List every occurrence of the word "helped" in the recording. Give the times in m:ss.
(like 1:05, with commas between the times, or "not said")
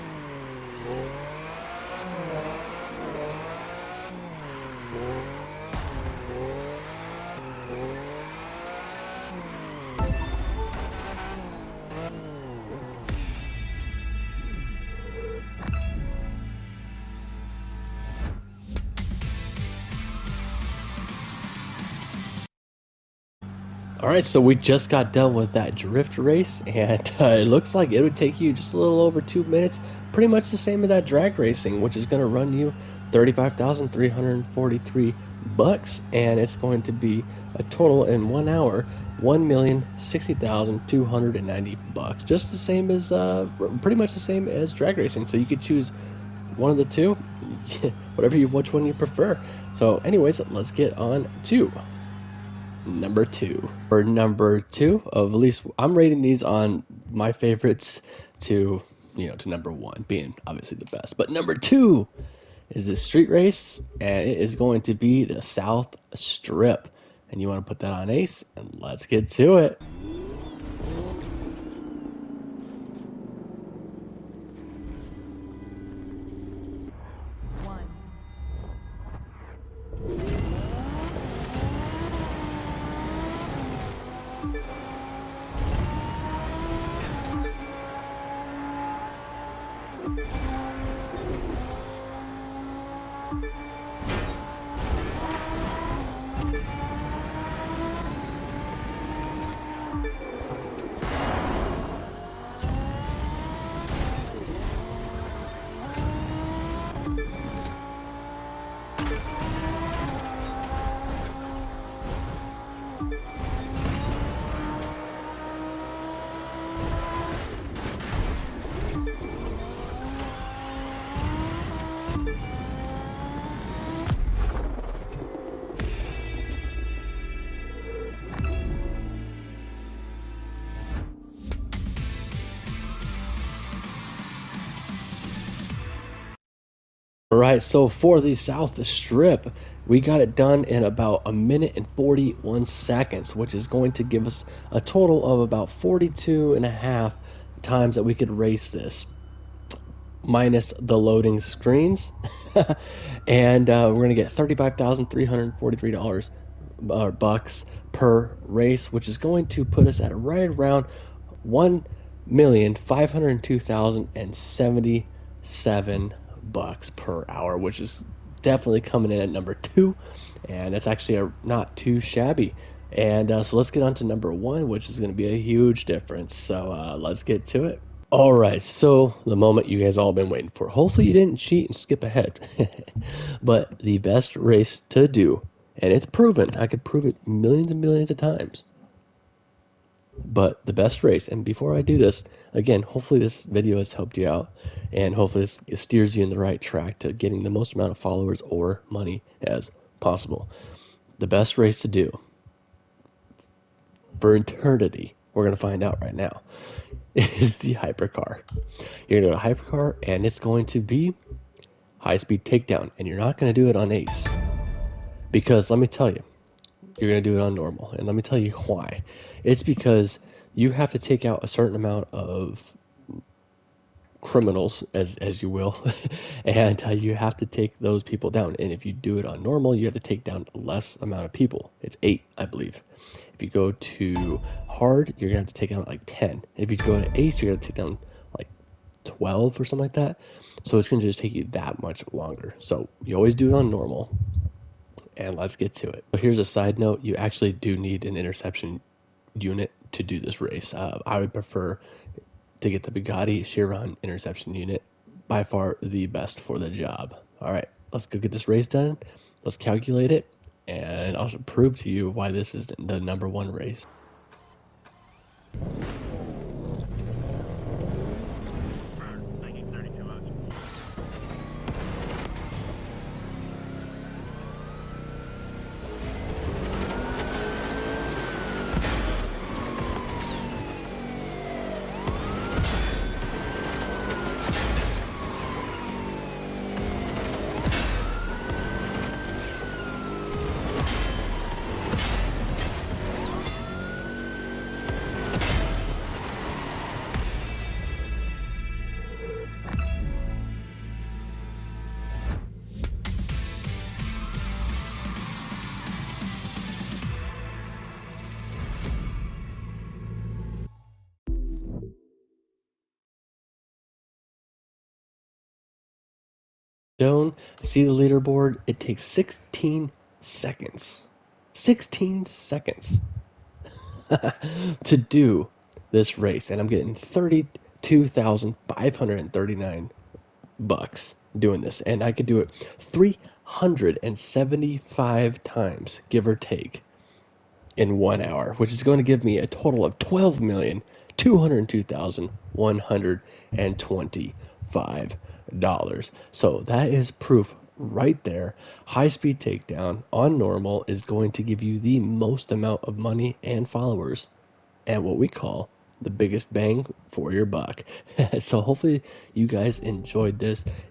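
3:13.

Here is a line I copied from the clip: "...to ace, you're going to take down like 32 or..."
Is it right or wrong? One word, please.
wrong.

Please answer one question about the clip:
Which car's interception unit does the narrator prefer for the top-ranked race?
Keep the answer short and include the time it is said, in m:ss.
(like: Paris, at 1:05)
Bugatti Chiron, at 4:12.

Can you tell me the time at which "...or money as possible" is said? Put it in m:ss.
3:18.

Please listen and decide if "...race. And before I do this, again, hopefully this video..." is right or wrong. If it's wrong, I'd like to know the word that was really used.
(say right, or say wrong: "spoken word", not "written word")
right.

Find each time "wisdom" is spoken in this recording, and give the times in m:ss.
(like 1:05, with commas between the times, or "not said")
not said.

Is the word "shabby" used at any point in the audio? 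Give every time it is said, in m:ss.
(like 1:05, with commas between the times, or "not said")
2:52.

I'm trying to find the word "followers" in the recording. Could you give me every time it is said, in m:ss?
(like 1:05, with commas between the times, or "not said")
3:17, 5:53.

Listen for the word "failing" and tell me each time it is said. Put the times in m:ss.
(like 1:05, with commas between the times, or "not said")
not said.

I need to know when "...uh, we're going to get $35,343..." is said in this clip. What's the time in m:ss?
2:33.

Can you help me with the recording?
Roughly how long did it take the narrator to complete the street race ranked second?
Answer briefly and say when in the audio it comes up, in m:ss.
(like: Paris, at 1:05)
1 minute 41 seconds, at 2:21.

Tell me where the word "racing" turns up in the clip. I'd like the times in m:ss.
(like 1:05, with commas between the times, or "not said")
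0:31, 0:44.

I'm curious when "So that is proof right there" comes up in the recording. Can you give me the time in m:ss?
5:46.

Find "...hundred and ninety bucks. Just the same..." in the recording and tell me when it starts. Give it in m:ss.
0:41.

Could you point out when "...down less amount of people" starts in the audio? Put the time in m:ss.
3:50.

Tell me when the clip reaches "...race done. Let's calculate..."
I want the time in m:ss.
4:18.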